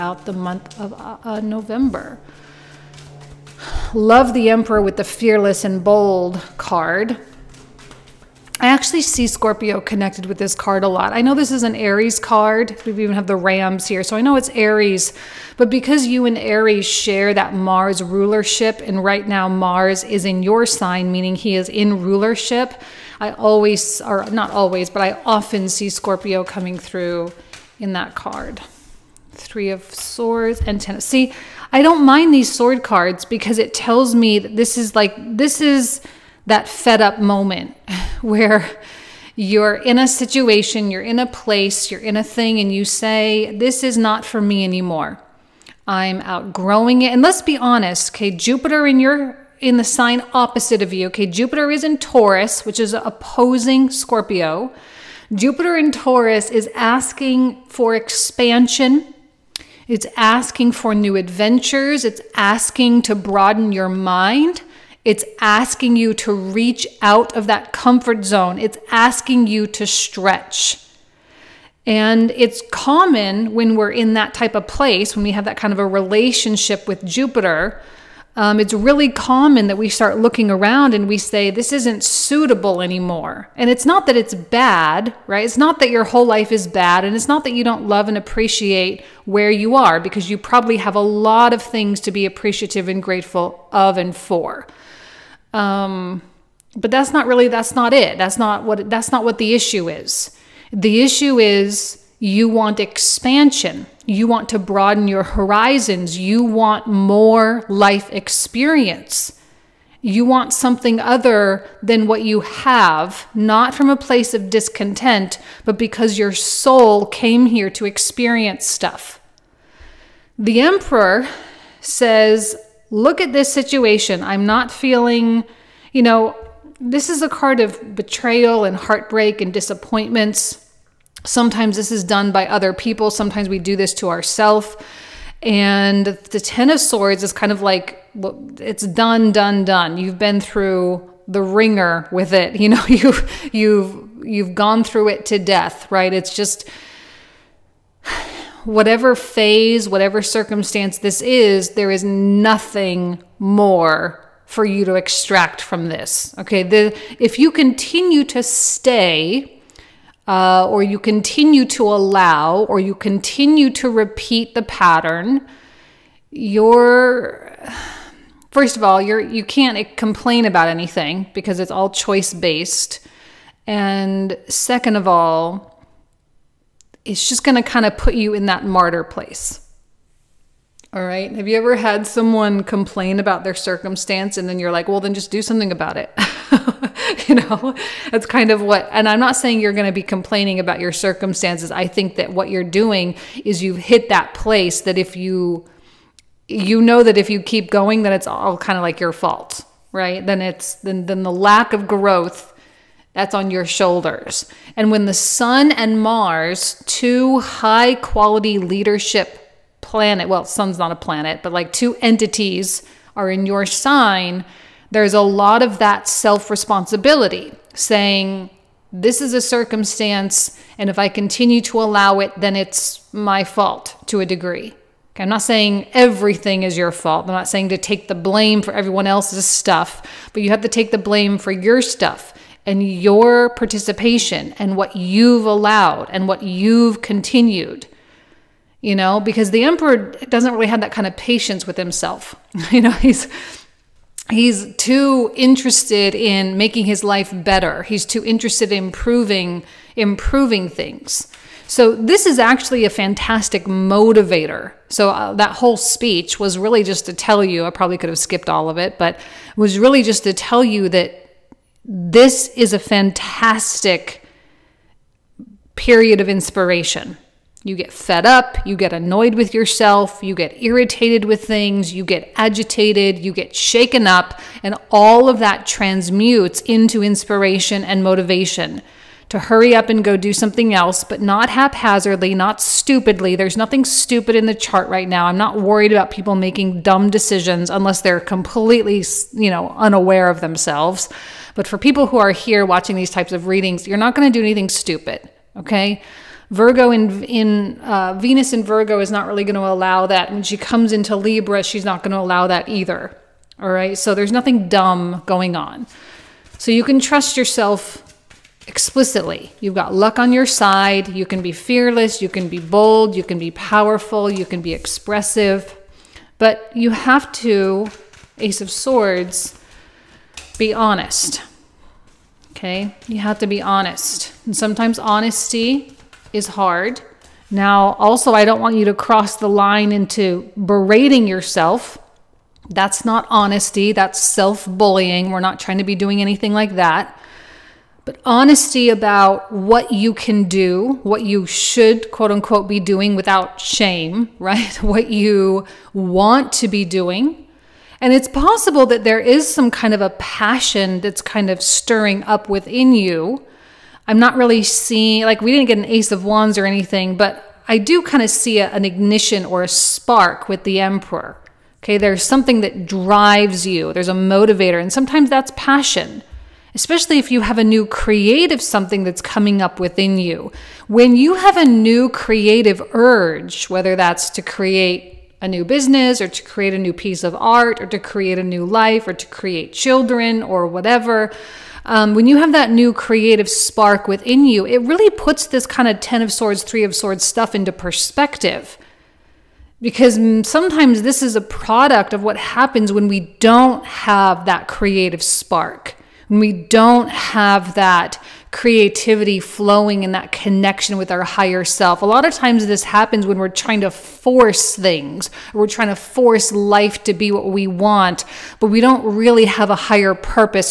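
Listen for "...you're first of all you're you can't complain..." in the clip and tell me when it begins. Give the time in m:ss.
2:46.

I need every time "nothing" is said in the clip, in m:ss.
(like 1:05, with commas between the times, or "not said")
2:32, 4:43, 5:04.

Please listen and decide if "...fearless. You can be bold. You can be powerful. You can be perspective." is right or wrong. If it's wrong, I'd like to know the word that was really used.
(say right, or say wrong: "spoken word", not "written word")
wrong: "expressive", not "perspective".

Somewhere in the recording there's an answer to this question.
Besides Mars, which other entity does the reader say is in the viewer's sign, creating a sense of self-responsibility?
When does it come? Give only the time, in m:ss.
3:25.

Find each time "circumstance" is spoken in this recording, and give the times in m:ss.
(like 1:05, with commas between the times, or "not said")
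2:30, 3:03, 3:10, 3:39.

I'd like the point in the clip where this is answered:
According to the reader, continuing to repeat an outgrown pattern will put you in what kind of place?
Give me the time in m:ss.
2:58.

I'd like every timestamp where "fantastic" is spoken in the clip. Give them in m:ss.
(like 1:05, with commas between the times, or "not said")
4:12, 4:22.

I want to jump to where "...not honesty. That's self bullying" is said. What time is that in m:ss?
5:33.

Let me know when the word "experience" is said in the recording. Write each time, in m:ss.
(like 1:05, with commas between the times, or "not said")
1:48, 1:57.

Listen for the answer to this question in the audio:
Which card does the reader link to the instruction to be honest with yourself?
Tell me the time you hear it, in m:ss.
5:18.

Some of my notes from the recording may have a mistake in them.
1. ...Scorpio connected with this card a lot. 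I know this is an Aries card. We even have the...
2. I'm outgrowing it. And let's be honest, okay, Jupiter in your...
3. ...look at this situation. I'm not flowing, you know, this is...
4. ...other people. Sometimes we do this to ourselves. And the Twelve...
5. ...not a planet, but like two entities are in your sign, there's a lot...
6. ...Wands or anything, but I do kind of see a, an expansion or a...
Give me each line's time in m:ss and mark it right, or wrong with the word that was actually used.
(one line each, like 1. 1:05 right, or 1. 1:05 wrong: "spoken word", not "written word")
1. 0:09 right
2. 0:45 right
3. 2:02 wrong: "feeling", not "flowing"
4. 2:12 wrong: "Ten", not "Twelve"
5. 3:30 right
6. 5:56 wrong: "ignition", not "expansion".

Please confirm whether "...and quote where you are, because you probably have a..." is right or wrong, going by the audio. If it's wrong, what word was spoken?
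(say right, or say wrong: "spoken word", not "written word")
wrong: "appreciate", not "quote".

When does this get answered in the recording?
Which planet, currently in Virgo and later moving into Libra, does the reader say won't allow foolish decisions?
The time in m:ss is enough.
4:58.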